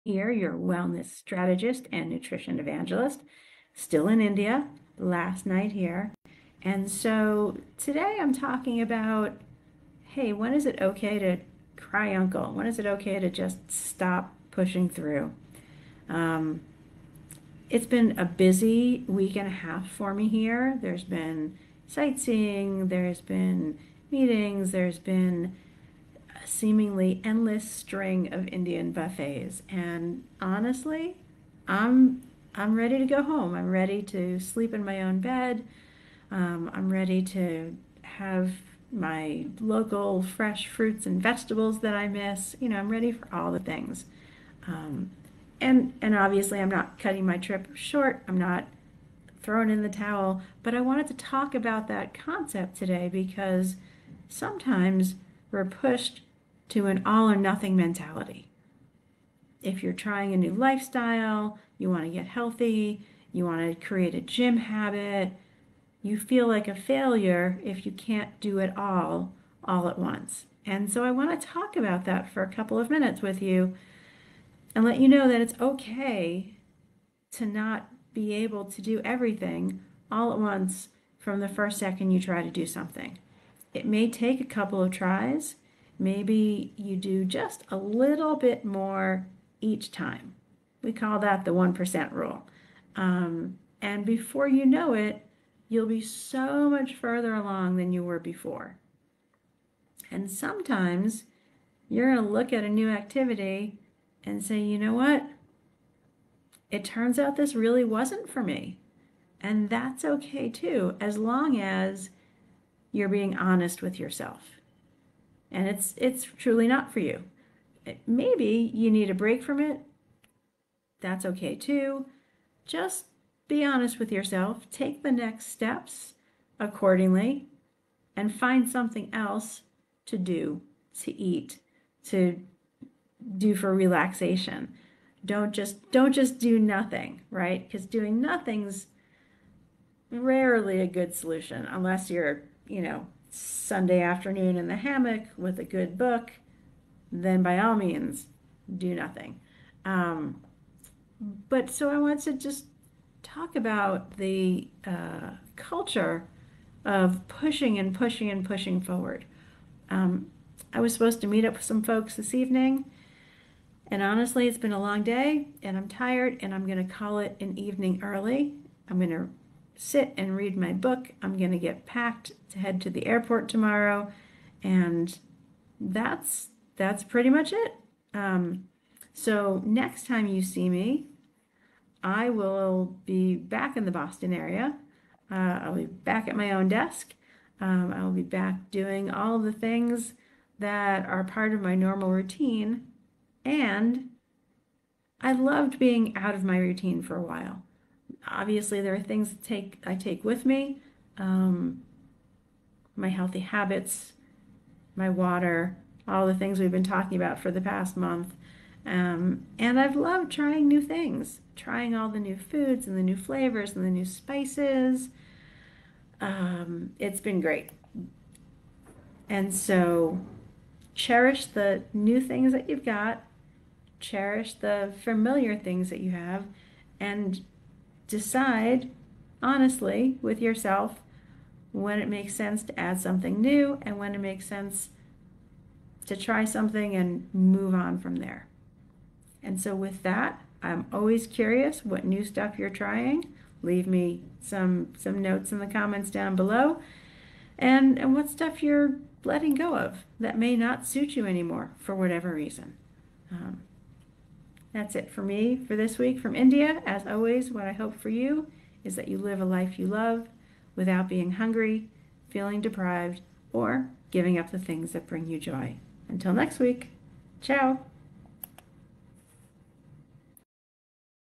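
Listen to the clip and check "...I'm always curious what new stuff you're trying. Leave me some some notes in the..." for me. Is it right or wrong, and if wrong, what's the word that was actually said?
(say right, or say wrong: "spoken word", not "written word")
right.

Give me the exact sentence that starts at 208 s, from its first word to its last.
Um, and I've loved trying new things, trying all the new foods and the new flavors and the new spices.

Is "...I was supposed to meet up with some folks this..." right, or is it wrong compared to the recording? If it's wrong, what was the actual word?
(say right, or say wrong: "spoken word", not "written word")
right.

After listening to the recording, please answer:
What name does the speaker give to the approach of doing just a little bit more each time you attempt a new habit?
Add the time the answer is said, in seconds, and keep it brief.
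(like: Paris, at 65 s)
1% rule, at 91 s.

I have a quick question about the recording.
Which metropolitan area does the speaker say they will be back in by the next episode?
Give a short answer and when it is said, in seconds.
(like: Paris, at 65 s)
Boston, at 183 s.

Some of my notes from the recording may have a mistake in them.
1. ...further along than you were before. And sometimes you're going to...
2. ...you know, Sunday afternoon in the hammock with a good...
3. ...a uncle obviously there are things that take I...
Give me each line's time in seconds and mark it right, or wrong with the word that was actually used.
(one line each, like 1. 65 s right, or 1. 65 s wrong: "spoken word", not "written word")
1. 96 s right
2. 142 s right
3. 197 s wrong: "while", not "uncle".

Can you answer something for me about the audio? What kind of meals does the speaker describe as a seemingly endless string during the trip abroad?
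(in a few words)
Indian buffets.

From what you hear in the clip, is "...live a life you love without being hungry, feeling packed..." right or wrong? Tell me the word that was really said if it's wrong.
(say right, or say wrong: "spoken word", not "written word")
wrong: "deprived", not "packed".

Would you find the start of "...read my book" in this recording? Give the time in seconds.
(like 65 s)
170 s.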